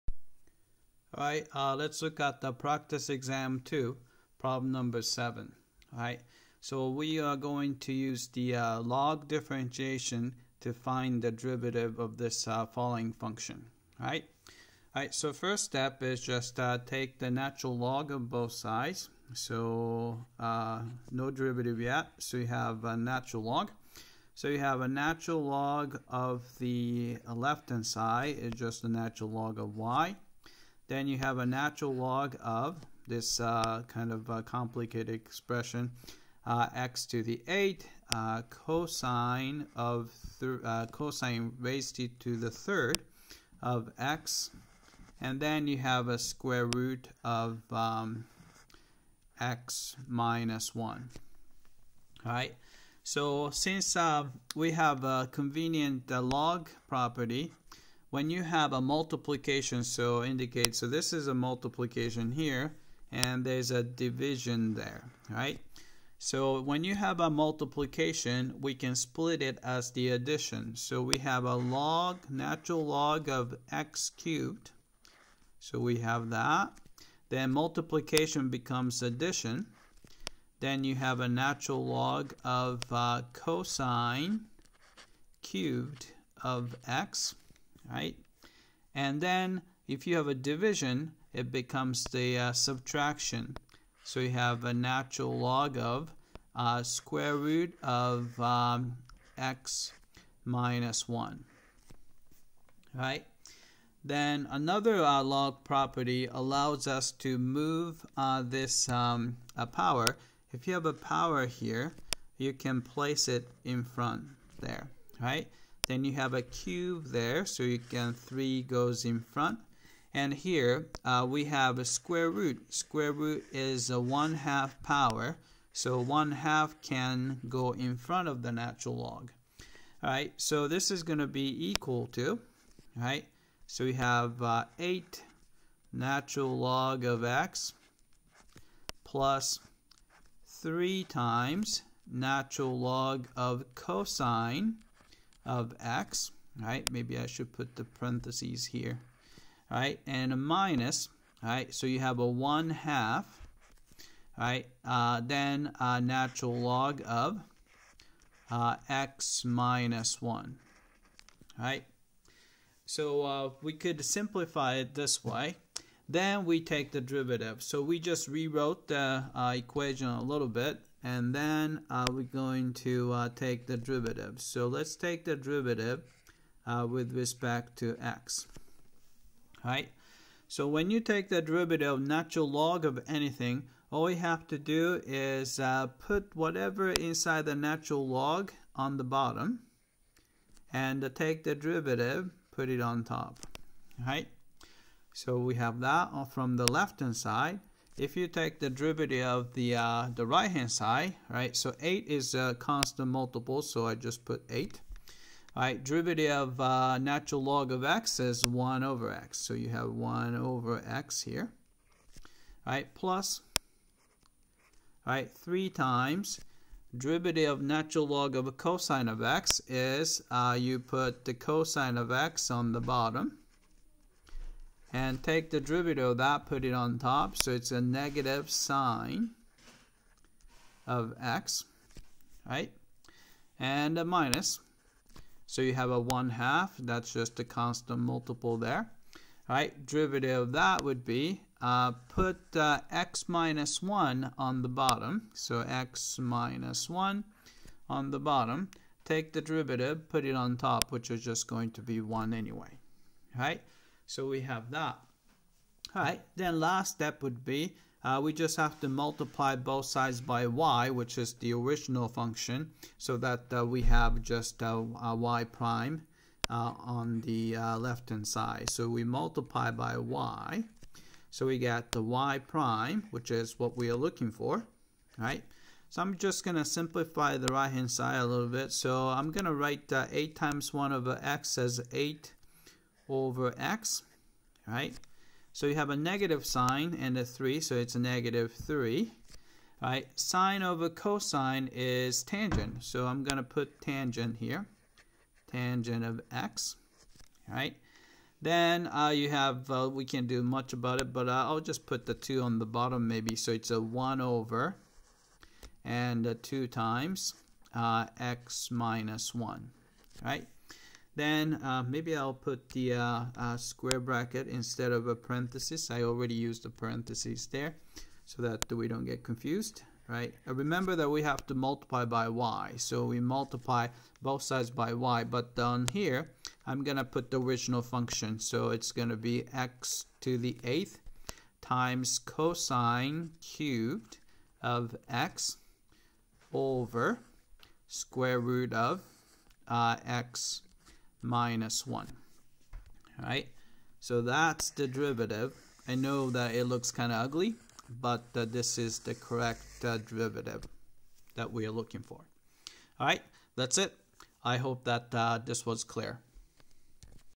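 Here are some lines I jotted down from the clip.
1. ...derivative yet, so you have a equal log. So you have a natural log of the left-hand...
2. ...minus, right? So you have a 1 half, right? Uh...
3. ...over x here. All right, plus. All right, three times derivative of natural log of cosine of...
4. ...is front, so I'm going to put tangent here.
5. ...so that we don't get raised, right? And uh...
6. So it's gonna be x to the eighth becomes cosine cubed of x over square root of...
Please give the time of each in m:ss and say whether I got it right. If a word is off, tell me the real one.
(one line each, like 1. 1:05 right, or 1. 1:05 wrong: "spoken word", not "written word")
1. 0:21 wrong: "natural", not "equal"
2. 2:30 right
3. 3:30 right
4. 4:51 wrong: "tangent", not "front"
5. 5:18 wrong: "confused", not "raised"
6. 5:28 wrong: "times", not "becomes".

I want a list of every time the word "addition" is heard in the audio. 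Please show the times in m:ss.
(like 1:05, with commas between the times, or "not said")
1:10, 1:19.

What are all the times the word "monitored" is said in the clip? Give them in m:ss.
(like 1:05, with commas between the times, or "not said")
not said.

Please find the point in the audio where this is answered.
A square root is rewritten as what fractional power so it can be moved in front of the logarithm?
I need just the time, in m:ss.
2:03.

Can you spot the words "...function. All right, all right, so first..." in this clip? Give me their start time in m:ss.
0:13.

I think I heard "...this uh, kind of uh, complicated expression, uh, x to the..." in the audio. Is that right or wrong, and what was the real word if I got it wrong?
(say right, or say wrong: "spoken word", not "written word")
right.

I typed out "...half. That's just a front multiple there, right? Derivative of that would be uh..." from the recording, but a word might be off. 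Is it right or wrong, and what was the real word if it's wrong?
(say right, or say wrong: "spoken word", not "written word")
wrong: "constant", not "front".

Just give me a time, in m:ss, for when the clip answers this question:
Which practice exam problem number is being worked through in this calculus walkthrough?
0:04.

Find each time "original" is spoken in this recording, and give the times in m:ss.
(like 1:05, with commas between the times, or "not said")
4:21, 5:27.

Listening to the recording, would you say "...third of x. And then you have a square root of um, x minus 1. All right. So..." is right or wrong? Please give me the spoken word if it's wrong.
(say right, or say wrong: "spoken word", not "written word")
right.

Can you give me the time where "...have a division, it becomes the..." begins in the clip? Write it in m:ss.
1:30.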